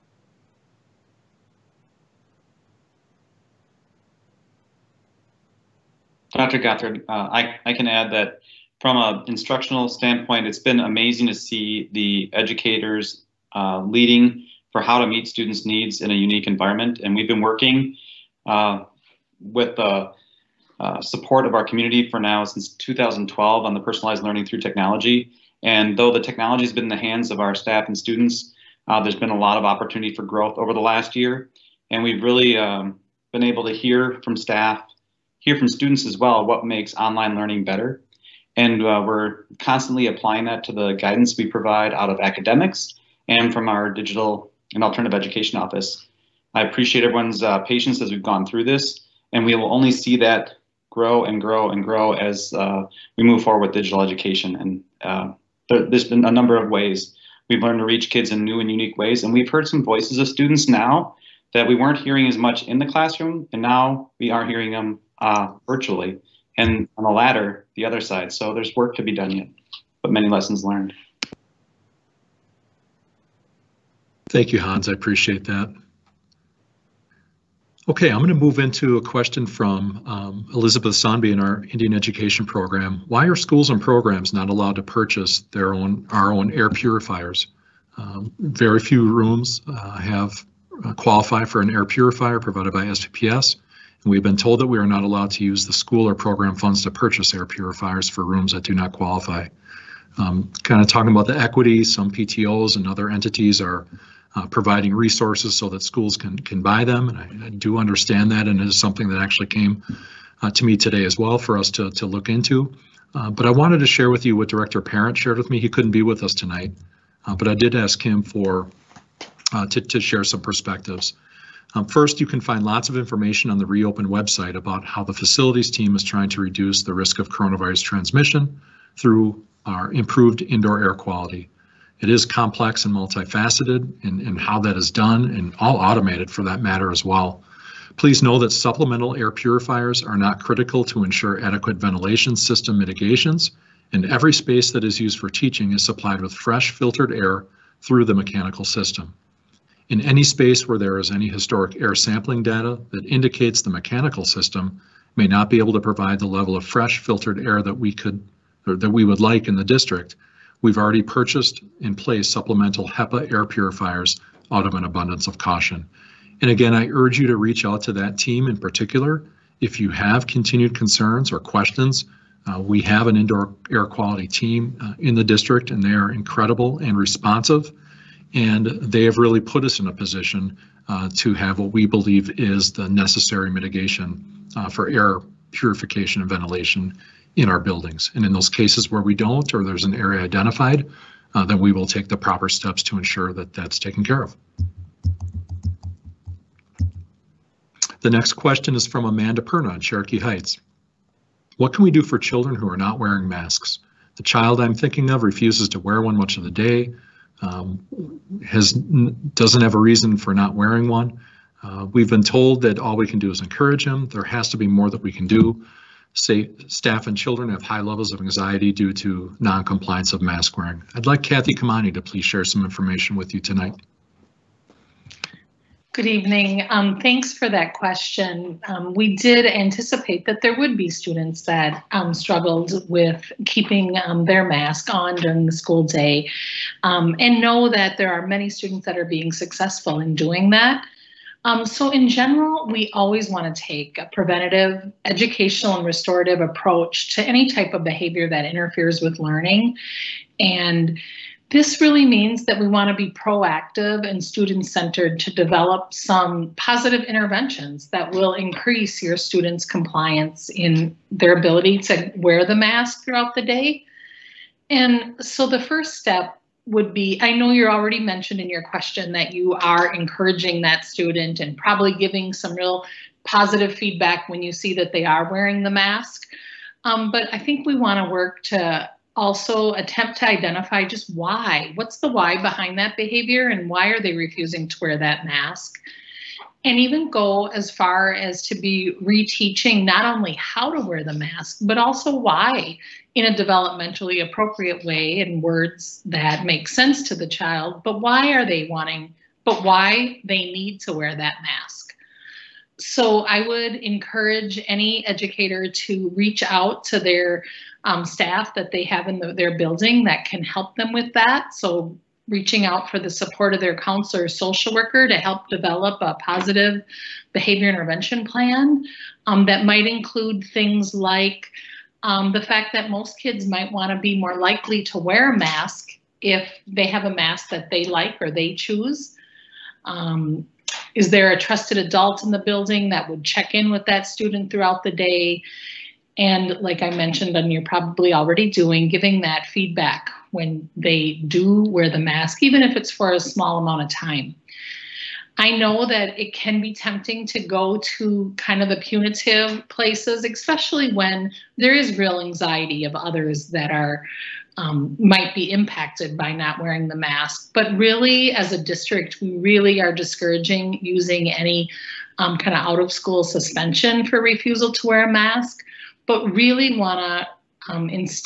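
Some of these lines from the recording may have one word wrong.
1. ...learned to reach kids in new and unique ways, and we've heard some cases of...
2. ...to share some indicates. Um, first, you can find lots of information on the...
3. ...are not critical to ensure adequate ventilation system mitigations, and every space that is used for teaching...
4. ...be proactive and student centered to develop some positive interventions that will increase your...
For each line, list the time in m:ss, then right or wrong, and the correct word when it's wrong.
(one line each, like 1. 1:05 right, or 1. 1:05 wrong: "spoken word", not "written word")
1. 0:57 wrong: "voices", not "cases"
2. 1:59 wrong: "perspectives", not "indicates"
3. 2:20 right
4. 4:12 right.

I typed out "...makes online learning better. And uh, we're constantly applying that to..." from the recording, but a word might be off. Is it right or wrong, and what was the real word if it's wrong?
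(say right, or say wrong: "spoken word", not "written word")
right.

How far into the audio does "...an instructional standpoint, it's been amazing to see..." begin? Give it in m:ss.
0:08.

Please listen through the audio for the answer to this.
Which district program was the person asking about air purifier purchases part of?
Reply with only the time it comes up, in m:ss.
1:21.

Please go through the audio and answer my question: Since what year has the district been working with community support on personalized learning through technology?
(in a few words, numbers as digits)
2012.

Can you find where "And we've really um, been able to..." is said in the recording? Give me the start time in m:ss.
0:31.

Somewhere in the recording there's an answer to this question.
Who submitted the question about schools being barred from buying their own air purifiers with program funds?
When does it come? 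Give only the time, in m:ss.
1:20.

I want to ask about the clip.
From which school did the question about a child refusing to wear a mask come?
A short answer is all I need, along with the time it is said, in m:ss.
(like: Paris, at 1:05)
Cherokee Heights, at 3:19.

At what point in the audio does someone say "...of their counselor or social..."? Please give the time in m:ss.
5:13.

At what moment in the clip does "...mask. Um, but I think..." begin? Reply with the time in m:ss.
4:35.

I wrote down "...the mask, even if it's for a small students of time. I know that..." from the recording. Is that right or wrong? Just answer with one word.
wrong.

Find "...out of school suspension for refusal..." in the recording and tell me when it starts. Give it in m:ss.
6:02.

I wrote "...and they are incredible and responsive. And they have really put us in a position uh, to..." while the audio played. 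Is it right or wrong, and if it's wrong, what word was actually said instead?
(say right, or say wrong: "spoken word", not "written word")
right.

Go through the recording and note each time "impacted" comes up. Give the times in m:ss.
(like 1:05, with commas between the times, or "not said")
5:55.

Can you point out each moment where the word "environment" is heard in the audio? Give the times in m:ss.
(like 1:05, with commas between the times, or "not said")
0:16.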